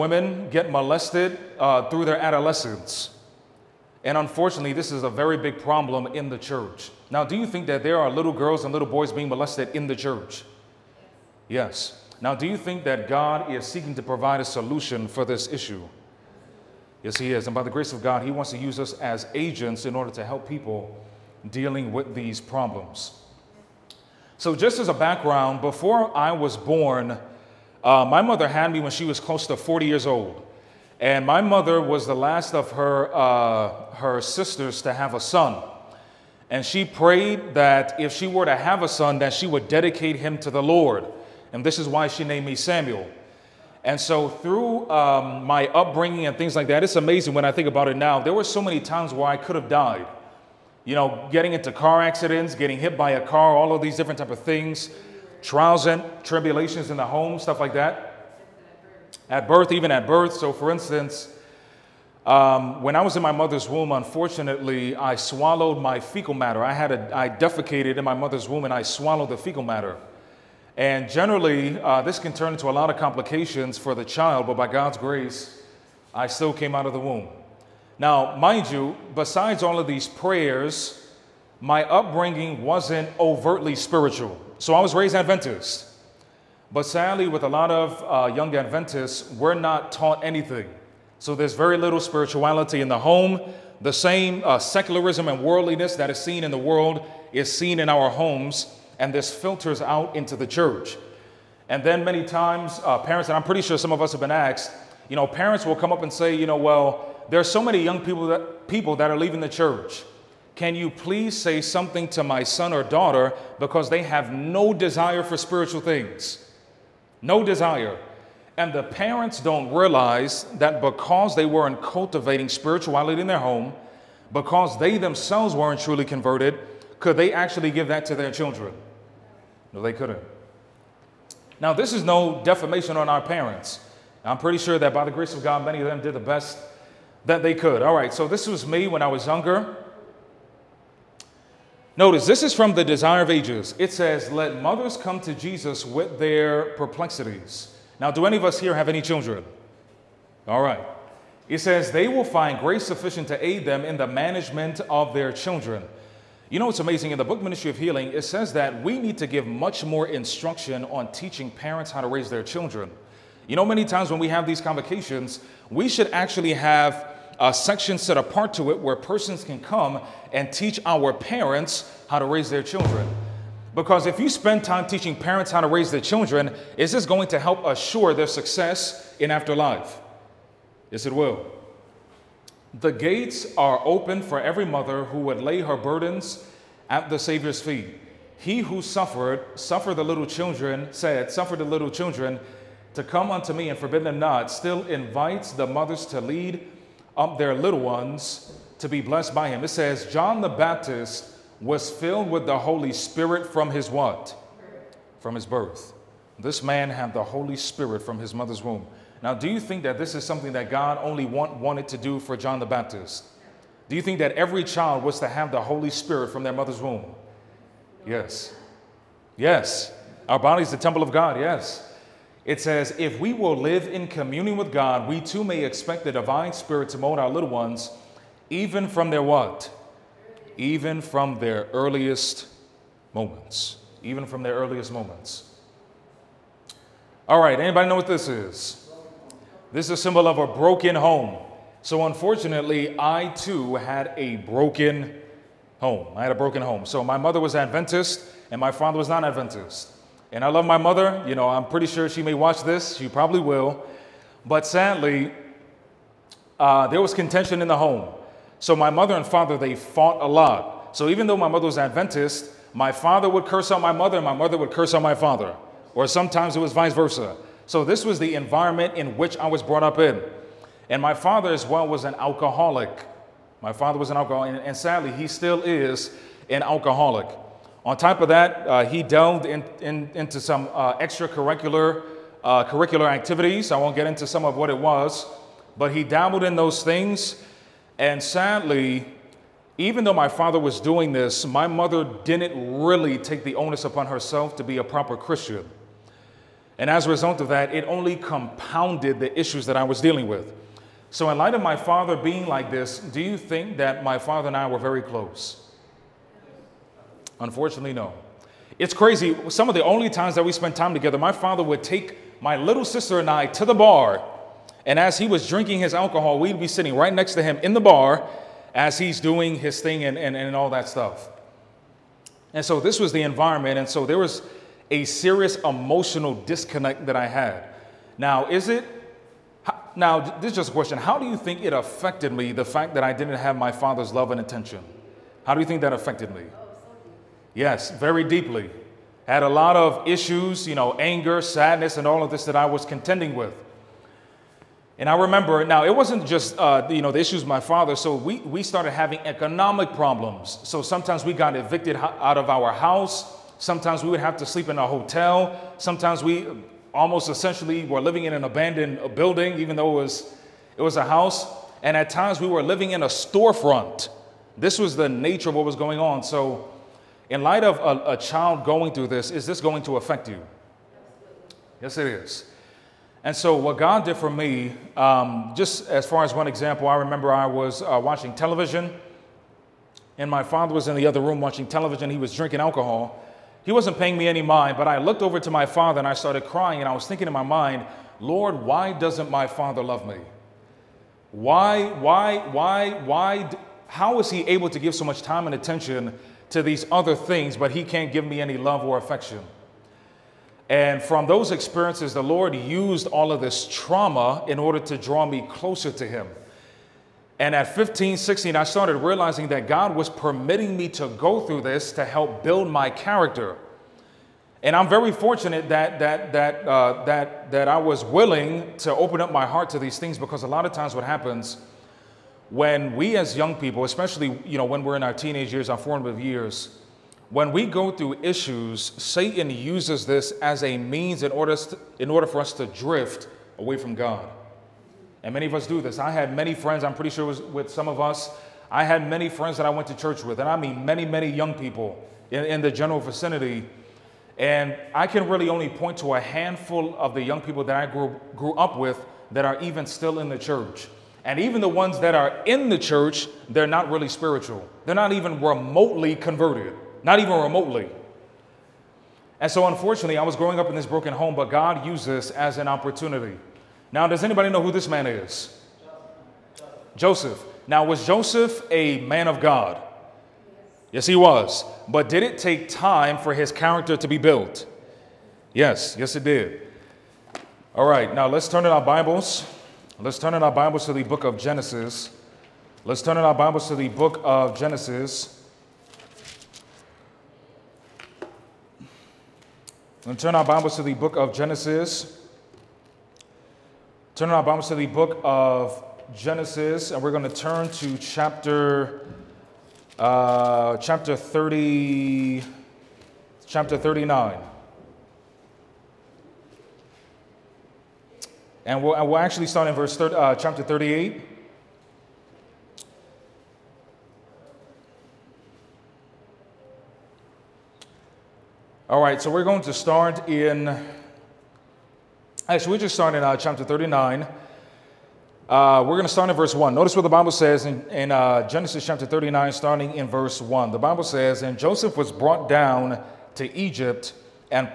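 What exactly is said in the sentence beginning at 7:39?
And so, unfortunately, I was growing up in this broken home, but God used this as an opportunity.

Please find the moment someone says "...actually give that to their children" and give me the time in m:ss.
2:07.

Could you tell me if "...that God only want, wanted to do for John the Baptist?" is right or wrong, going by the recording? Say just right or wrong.
right.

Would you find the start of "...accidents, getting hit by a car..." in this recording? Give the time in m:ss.
0:52.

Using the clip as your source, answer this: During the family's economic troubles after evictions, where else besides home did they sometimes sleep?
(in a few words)
a hotel.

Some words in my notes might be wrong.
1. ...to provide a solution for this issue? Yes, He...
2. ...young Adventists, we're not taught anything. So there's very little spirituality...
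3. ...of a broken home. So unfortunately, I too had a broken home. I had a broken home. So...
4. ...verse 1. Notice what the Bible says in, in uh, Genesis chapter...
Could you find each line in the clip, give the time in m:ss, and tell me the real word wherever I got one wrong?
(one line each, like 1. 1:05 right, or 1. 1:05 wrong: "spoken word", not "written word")
1. 0:13 right
2. 1:28 right
3. 4:00 right
4. 8:46 right.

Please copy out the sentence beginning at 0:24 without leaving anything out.
So, just as a background, before I was born, uh, my mother had me when she was close to 40 years old.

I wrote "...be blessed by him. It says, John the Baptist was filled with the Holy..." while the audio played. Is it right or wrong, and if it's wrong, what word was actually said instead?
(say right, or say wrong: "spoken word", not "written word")
right.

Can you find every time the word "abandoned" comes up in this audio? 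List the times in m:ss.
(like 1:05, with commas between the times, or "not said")
5:58.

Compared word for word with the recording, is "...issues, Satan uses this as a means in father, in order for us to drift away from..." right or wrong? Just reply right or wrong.
wrong.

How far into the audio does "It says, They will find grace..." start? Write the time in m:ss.
2:31.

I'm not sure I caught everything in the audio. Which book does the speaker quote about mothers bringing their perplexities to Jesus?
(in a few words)
The Desire of Ages.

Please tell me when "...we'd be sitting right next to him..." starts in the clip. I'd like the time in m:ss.
5:16.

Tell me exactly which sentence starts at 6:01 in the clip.
And at times we were living in a storefront.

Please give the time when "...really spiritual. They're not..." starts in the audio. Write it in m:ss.
7:33.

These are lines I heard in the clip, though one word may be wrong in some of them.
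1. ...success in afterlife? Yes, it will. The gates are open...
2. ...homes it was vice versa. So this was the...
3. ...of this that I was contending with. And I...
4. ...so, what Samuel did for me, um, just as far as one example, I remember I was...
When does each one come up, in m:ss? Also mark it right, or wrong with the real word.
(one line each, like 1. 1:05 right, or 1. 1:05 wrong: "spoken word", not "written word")
1. 2:58 right
2. 4:26 wrong: "sometimes", not "homes"
3. 5:42 right
4. 6:13 wrong: "God", not "Samuel".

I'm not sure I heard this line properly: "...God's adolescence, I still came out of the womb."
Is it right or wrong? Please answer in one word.
wrong.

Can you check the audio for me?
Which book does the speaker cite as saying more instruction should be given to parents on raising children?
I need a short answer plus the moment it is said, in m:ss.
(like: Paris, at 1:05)
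Ministry of Healing, at 2:37.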